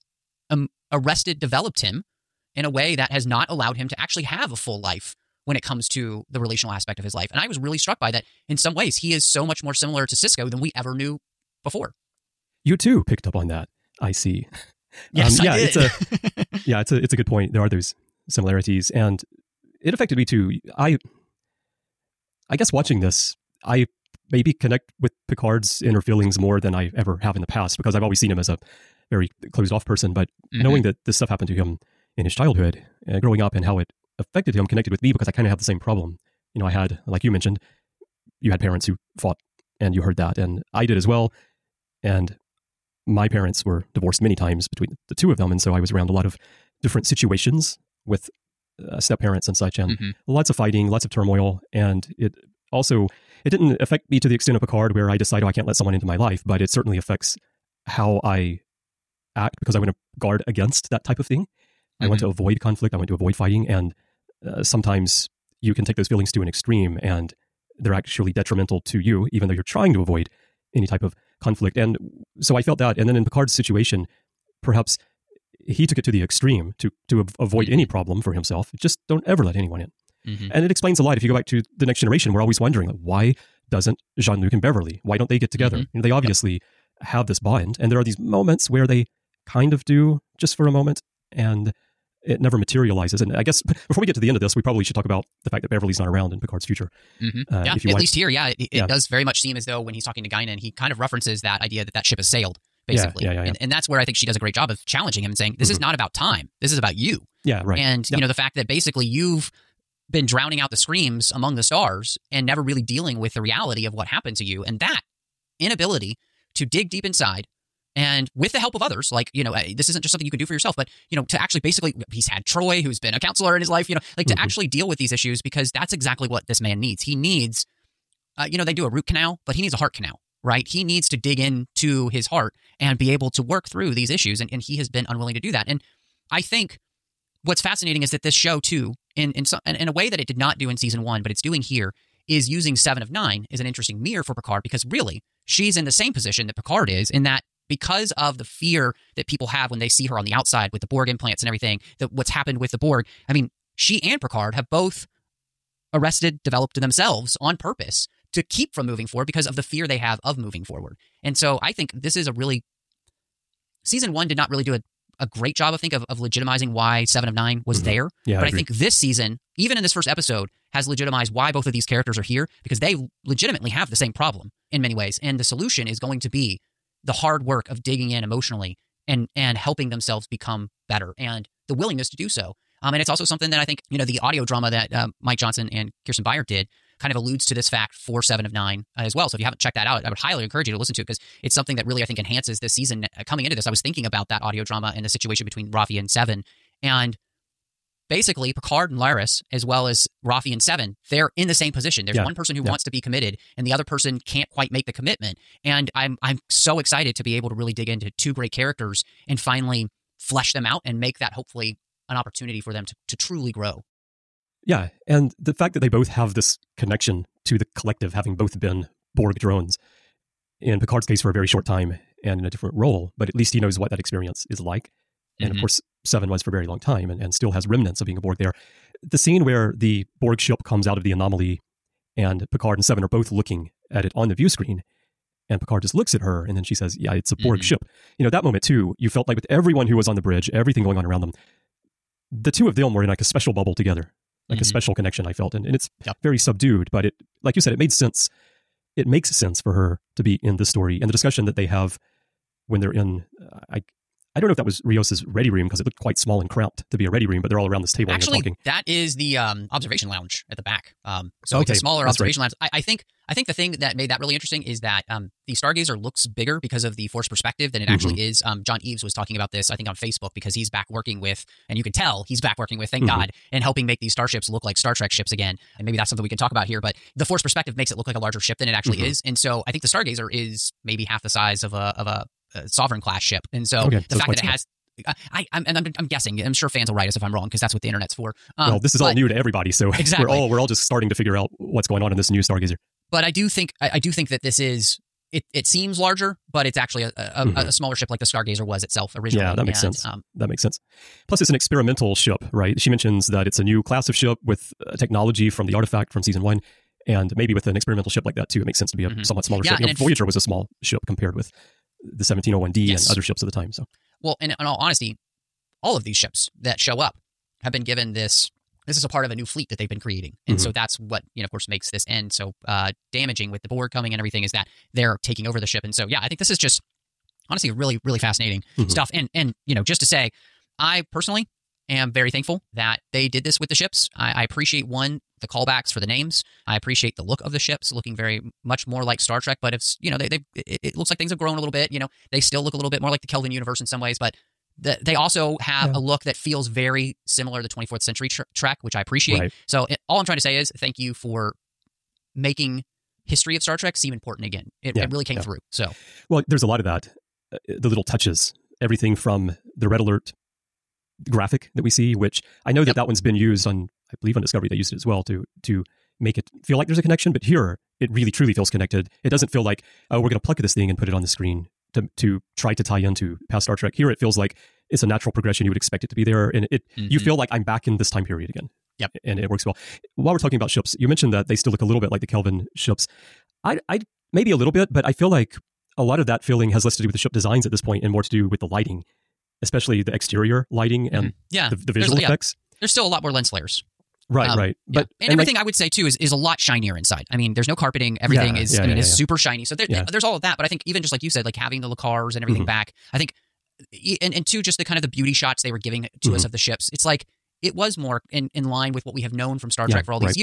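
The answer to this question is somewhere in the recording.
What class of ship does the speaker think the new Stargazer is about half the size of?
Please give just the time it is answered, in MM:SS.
04:42.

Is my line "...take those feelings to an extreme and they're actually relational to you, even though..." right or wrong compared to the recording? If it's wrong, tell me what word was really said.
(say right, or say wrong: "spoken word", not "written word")
wrong: "detrimental", not "relational".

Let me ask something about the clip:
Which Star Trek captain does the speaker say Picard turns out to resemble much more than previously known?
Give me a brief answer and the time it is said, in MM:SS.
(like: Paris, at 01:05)
Sisko, at 00:10.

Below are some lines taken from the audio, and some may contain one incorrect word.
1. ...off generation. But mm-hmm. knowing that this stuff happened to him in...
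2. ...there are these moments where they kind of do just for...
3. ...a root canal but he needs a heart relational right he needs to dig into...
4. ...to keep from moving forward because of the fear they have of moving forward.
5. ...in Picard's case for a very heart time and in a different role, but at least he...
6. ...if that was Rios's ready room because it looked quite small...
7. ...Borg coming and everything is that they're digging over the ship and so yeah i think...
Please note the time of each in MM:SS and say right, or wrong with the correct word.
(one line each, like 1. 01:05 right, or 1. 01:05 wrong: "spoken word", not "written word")
1. 00:29 wrong: "person", not "generation"
2. 01:27 right
3. 02:08 wrong: "canal", not "relational"
4. 02:38 right
5. 03:40 wrong: "short", not "heart"
6. 04:14 right
7. 05:23 wrong: "taking", not "digging".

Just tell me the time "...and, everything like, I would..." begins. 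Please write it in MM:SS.
06:35.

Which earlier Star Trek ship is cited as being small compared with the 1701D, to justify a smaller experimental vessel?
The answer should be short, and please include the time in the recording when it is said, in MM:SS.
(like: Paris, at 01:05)
Voyager, at 05:09.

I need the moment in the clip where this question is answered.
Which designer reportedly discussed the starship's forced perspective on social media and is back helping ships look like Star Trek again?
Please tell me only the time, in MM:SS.
04:28.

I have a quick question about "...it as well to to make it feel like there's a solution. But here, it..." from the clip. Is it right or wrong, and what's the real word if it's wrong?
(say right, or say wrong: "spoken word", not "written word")
wrong: "connection", not "solution".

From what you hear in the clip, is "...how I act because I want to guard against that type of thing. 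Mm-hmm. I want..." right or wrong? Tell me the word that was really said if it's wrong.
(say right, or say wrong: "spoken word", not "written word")
right.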